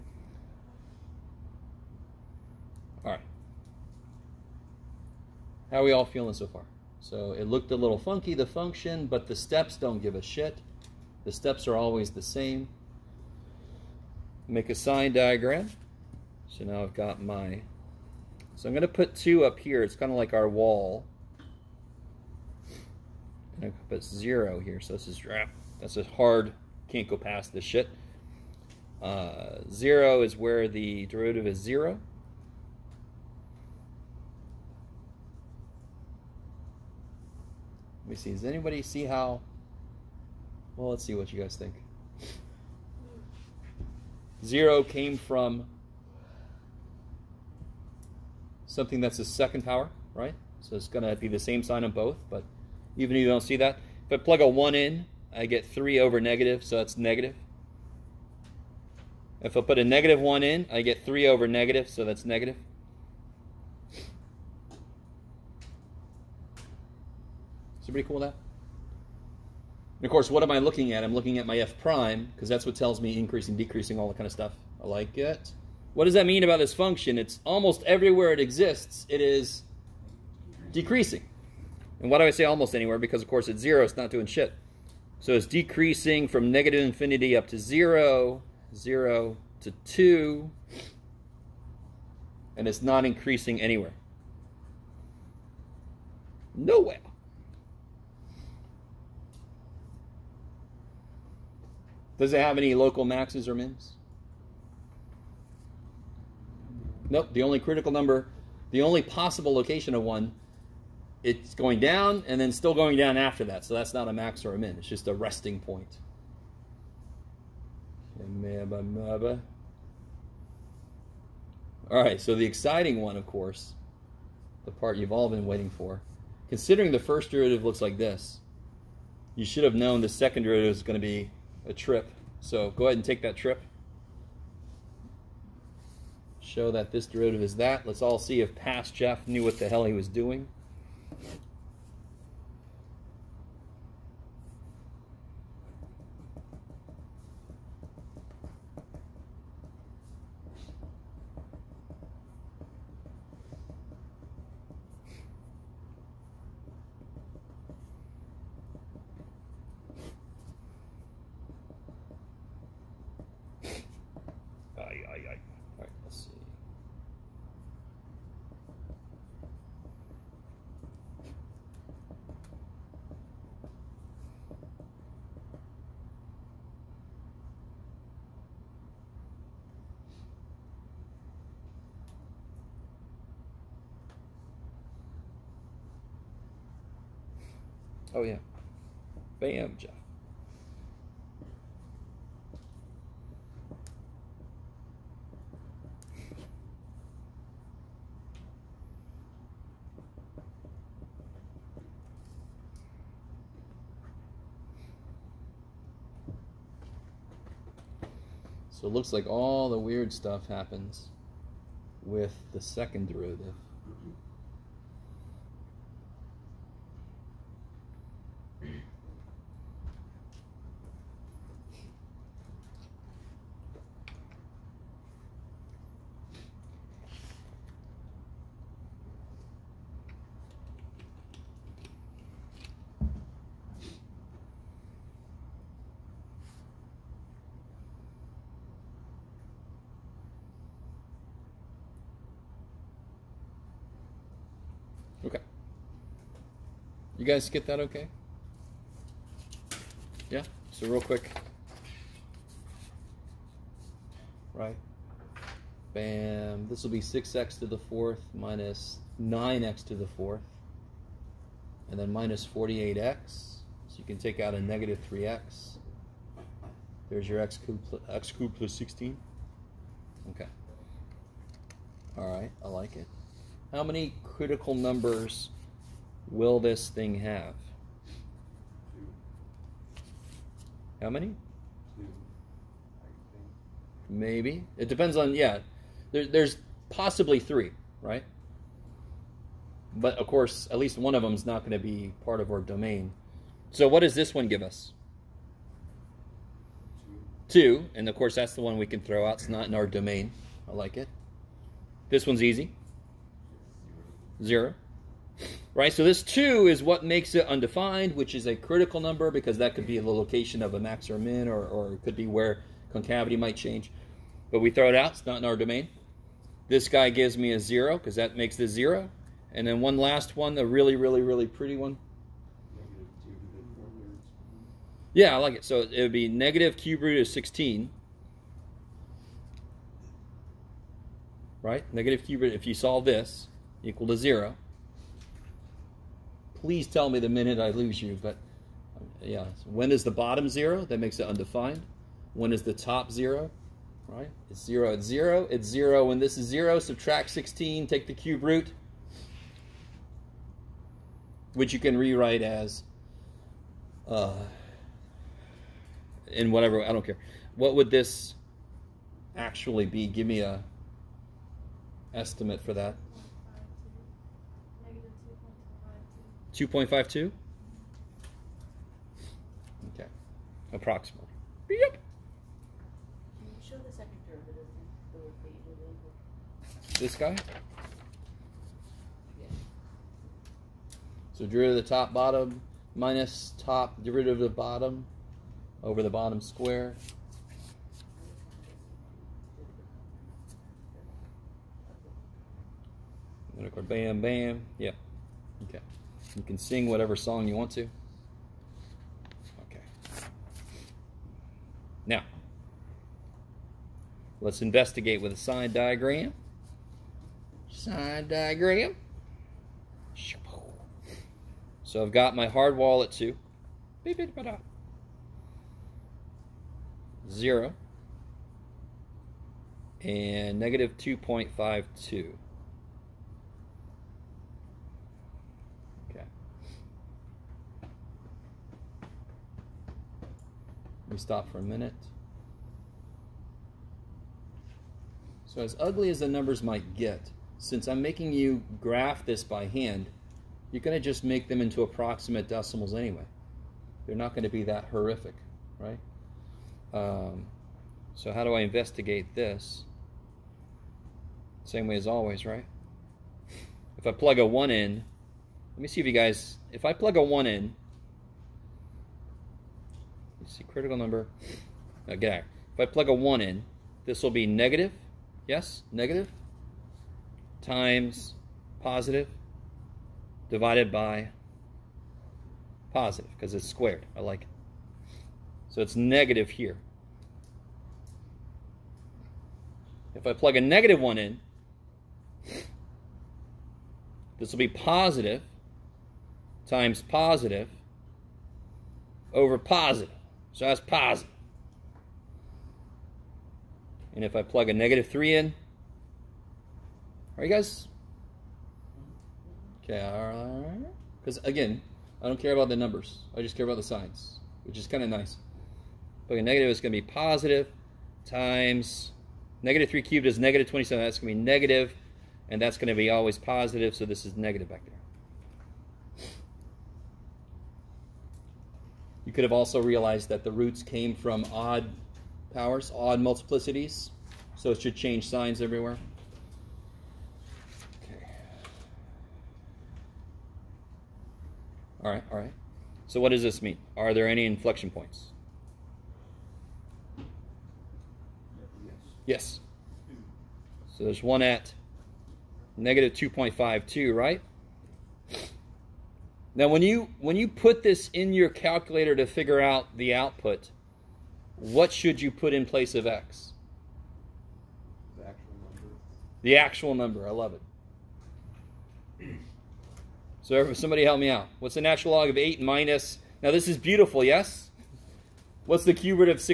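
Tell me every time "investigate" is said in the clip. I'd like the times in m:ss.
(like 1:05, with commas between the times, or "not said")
6:44, 7:28.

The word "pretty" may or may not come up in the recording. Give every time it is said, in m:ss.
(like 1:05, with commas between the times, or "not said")
1:07, 5:21.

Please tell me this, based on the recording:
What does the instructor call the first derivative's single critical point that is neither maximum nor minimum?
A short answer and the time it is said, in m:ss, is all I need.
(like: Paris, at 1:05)
a resting point, at 1:55.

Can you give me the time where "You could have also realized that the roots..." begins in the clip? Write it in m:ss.
8:39.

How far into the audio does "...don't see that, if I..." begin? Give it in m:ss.
0:53.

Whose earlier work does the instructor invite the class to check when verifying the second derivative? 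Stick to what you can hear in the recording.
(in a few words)
past Jeff.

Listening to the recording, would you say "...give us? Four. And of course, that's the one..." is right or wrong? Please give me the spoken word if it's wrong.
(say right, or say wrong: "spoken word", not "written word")
wrong: "Two", not "Four".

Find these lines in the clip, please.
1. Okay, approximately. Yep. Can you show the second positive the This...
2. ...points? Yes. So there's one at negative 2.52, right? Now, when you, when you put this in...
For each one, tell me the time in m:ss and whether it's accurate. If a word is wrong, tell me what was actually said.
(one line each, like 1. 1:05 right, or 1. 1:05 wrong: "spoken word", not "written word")
1. 6:09 wrong: "derivative", not "positive"
2. 8:54 right.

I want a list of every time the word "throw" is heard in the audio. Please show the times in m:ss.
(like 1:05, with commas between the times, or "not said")
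4:58, 5:14.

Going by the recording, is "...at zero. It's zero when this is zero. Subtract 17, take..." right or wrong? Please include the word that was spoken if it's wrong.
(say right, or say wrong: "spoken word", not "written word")
wrong: "16", not "17".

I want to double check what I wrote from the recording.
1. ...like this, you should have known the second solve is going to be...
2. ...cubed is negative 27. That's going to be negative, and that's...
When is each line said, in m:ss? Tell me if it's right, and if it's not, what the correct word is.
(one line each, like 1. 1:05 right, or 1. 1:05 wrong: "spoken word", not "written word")
1. 2:07 wrong: "derivative", not "solve"
2. 8:30 right.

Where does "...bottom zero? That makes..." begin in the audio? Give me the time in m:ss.
5:40.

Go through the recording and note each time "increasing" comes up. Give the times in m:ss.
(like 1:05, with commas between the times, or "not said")
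1:13, 1:33.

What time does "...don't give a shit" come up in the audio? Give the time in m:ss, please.
0:09.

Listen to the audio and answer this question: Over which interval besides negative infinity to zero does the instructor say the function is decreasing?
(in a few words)
zero to two.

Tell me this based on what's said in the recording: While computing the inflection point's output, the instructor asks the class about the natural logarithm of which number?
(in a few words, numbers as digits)
8.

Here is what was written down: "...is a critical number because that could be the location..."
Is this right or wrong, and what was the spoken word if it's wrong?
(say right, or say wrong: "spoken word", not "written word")
right.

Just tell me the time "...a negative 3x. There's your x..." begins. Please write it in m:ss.
4:24.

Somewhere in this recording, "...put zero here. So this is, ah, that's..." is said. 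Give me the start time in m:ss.
0:23.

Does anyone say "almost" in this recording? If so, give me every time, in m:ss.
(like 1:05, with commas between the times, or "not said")
1:17, 1:22.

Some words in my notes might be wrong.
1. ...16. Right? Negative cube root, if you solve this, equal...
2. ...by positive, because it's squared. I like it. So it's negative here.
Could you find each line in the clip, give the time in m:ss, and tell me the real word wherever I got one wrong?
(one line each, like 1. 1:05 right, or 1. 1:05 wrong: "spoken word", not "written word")
1. 5:27 right
2. 7:50 right.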